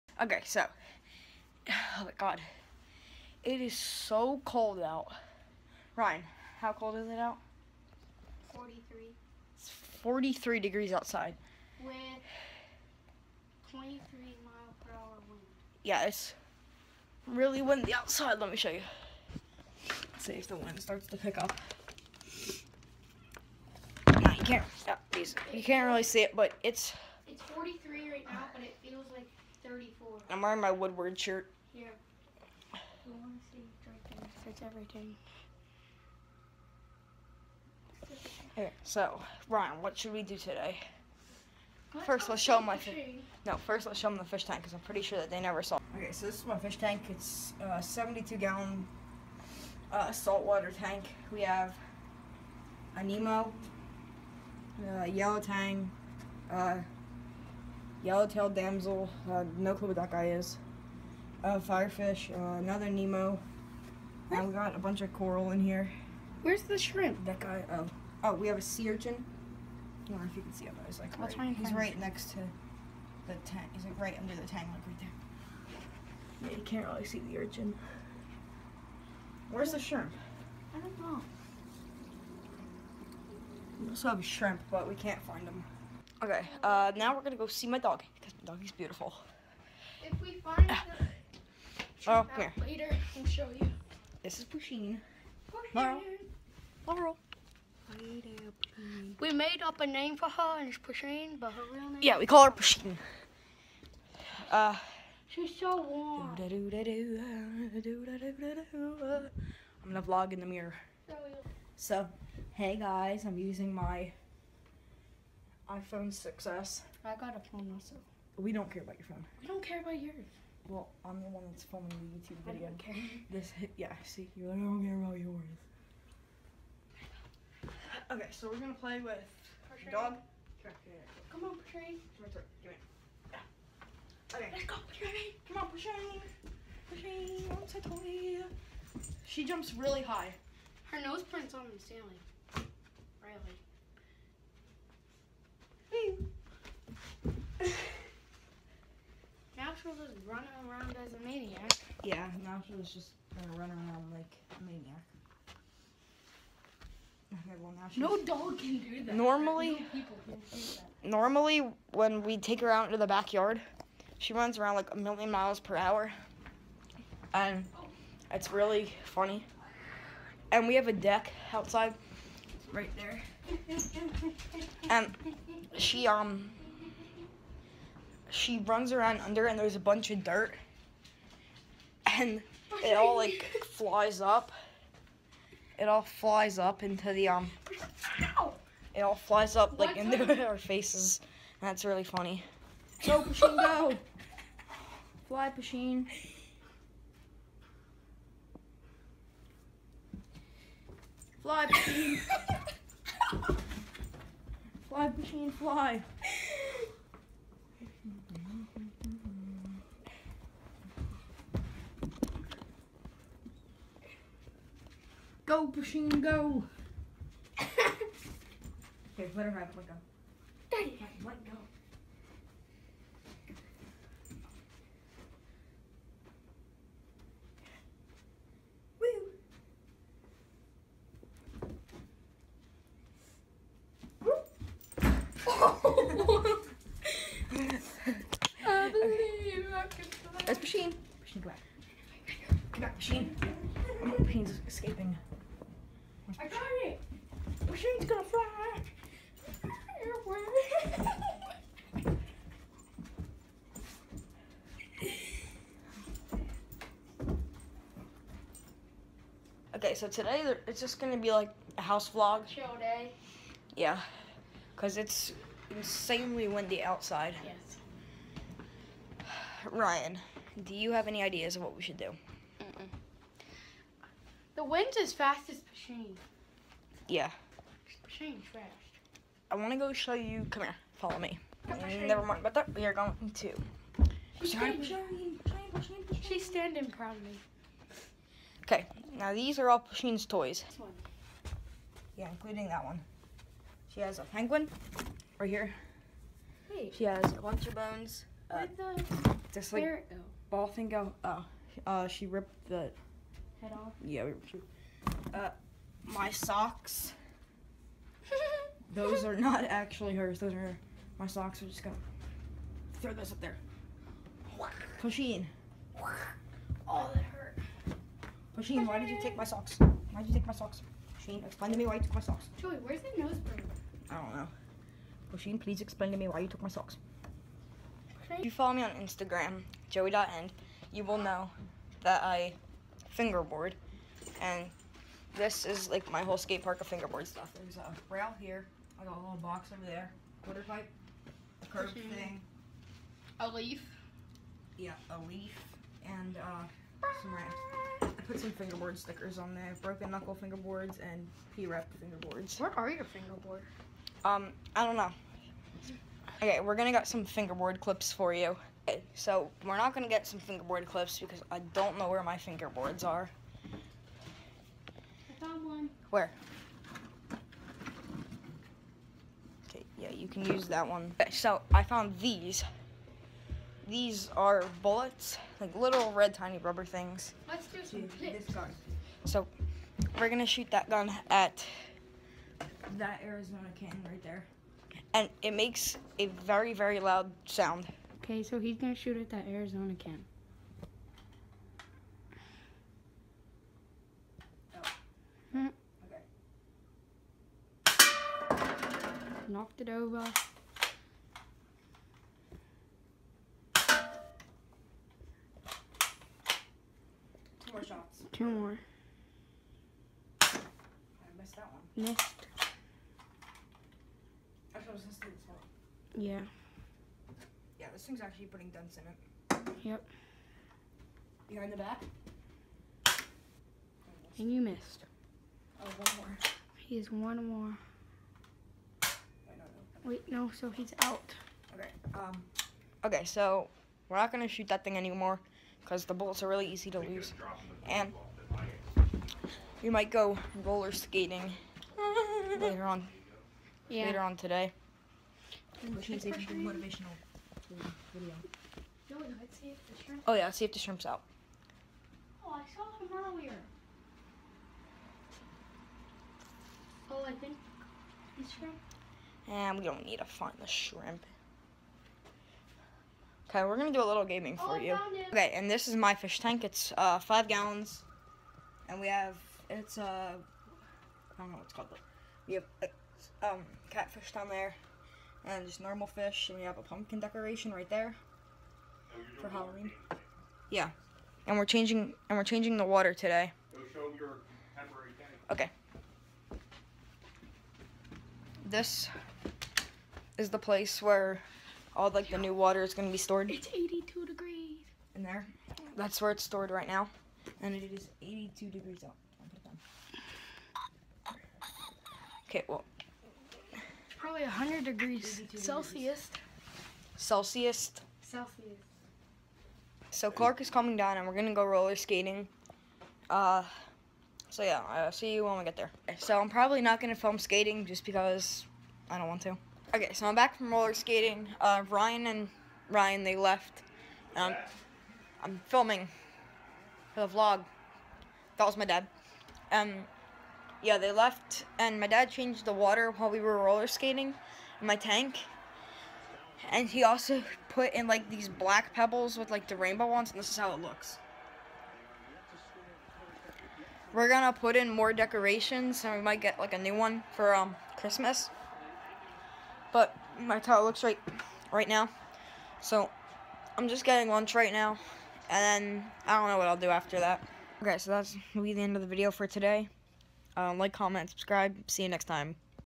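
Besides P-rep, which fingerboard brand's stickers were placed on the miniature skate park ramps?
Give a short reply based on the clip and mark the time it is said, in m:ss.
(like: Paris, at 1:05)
Broken Knuckle, at 5:49.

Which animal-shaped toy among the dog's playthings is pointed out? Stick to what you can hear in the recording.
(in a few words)
penguin.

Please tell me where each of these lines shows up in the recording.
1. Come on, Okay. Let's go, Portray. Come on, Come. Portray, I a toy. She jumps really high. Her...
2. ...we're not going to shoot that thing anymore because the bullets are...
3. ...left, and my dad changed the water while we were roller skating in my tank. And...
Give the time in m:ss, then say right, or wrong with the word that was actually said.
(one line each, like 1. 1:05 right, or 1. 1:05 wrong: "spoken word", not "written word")
1. 2:12 wrong: "Portray", not "Come"
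2. 7:14 right
3. 8:51 right.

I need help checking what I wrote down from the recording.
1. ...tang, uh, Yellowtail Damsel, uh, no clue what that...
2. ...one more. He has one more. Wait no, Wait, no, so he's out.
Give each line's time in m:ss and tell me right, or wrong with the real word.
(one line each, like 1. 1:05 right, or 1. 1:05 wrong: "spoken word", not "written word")
1. 0:55 right
2. 7:05 right.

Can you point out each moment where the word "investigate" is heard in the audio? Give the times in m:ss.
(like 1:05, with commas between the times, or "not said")
not said.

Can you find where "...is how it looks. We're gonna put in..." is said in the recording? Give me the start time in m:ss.
9:00.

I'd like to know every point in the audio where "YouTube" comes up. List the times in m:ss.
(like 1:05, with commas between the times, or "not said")
2:02.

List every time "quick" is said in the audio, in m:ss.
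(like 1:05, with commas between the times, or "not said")
not said.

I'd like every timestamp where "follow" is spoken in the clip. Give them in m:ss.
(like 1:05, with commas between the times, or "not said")
4:40, 5:28.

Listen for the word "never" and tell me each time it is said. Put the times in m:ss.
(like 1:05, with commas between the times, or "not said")
0:45, 4:42.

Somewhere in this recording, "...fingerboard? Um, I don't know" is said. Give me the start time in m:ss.
5:53.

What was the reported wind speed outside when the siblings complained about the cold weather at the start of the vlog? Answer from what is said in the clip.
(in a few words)
23 mph.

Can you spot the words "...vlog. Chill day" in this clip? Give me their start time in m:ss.
4:22.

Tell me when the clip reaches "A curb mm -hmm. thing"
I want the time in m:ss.
5:41.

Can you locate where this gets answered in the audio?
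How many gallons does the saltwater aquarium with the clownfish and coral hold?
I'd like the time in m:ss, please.
0:47.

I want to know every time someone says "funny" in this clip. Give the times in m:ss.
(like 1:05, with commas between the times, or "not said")
2:49, 3:12.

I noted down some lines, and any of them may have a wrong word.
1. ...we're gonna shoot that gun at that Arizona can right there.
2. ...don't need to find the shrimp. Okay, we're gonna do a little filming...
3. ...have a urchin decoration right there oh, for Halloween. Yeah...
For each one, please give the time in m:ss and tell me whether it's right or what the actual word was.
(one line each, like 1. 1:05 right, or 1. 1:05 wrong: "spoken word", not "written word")
1. 6:20 right
2. 7:39 wrong: "gaming", not "filming"
3. 7:56 wrong: "pumpkin", not "urchin".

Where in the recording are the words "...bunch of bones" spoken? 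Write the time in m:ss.
4:57.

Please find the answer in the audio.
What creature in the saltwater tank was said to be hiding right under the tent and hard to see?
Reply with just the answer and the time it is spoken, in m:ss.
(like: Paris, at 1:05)
sea urchin, at 1:08.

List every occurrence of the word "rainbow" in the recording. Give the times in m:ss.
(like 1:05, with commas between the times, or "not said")
8:59.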